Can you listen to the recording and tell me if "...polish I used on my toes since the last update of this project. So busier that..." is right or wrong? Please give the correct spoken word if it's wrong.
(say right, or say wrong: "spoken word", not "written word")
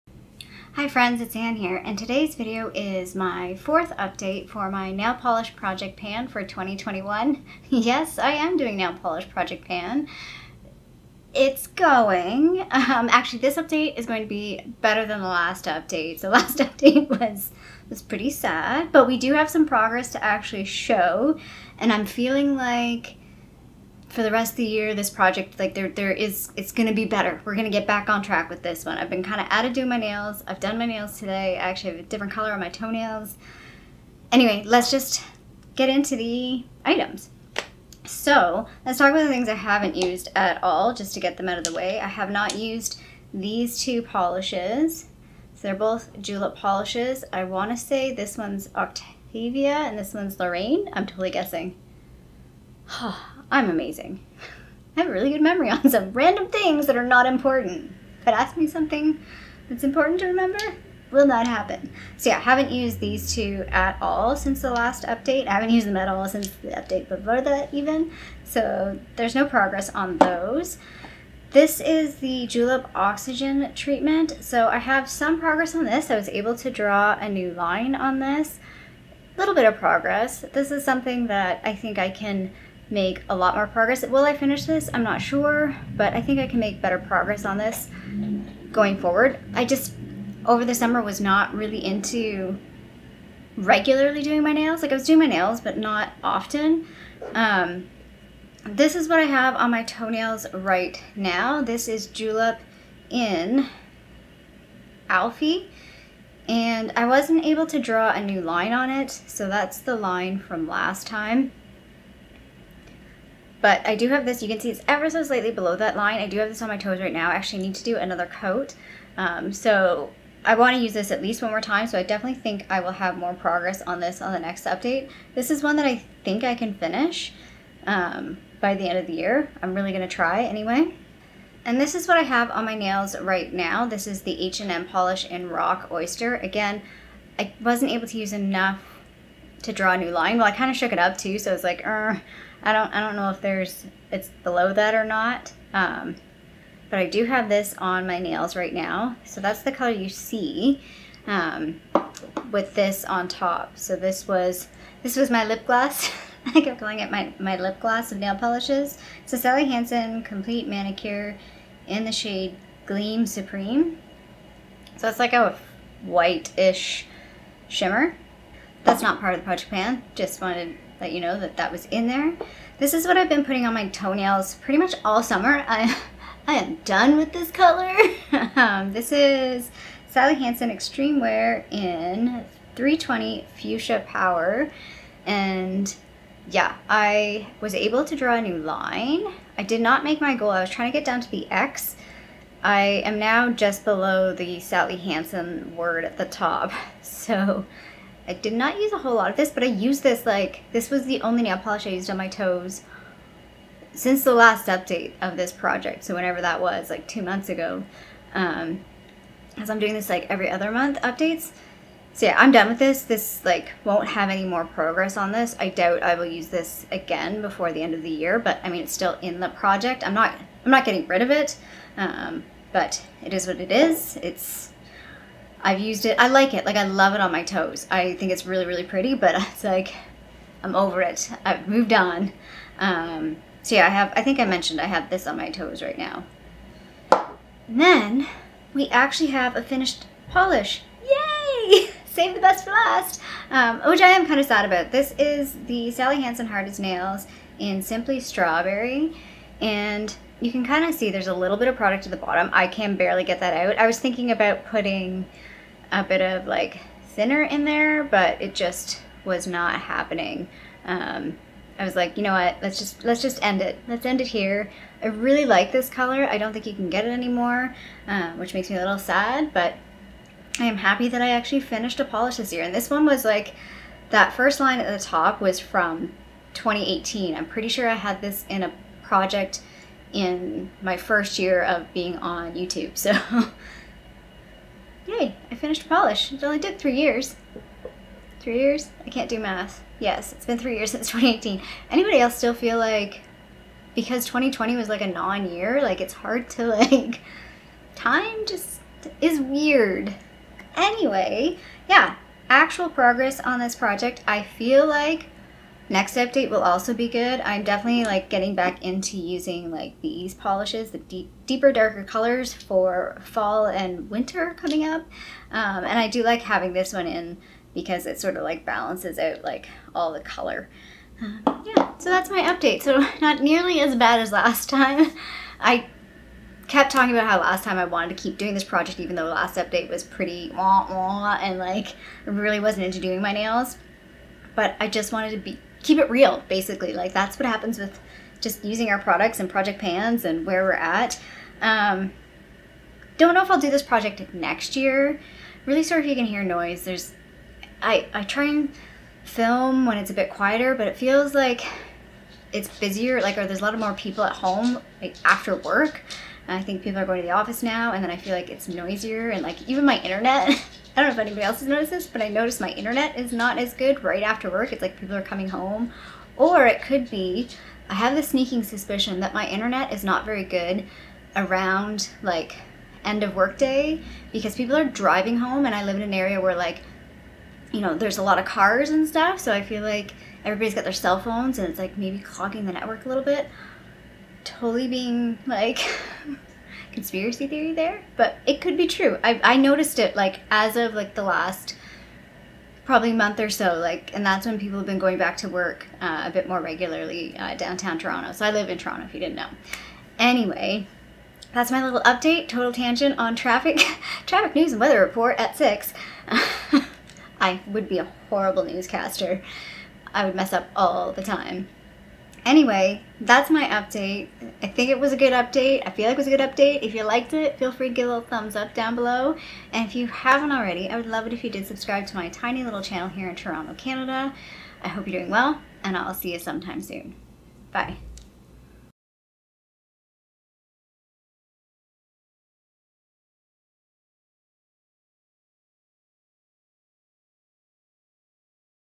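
wrong: "whenever", not "busier".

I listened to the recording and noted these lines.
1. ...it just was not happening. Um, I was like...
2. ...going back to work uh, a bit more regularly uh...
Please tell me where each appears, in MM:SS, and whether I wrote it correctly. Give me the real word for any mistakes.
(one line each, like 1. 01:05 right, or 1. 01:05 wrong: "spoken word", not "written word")
1. 04:18 right
2. 06:34 right.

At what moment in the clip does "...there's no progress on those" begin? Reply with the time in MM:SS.
01:09.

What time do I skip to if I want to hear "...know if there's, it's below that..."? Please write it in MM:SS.
02:23.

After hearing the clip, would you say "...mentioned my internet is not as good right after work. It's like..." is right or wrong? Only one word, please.
wrong.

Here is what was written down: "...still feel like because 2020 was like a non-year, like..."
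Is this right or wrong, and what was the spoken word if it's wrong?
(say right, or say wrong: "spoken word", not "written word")
right.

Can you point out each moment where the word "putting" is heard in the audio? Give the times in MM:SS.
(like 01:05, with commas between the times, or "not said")
02:53, 04:14.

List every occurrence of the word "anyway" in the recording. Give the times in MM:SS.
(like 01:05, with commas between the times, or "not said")
00:34, 02:10, 05:00, 06:40, 06:52.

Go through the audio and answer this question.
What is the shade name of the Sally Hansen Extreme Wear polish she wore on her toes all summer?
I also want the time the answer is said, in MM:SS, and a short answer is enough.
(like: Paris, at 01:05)
Fuchsia Power, at 03:03.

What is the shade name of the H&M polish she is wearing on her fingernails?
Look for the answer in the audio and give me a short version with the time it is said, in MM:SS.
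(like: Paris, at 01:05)
Rock Oyster, at 02:15.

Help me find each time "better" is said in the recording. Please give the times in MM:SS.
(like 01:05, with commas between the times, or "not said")
00:14, 00:27, 01:26.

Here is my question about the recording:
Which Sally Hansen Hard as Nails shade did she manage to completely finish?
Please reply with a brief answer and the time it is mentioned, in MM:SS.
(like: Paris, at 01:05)
Simply Strawberry, at 04:07.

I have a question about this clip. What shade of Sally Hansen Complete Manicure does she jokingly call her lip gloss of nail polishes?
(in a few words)
Gleam Supreme.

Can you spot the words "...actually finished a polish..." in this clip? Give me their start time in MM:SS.
04:31.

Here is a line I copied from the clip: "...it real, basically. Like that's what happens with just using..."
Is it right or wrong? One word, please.
right.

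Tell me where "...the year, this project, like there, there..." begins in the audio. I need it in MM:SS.
00:24.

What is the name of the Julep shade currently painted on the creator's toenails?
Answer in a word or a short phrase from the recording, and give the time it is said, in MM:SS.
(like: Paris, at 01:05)
Alfie, at 01:45.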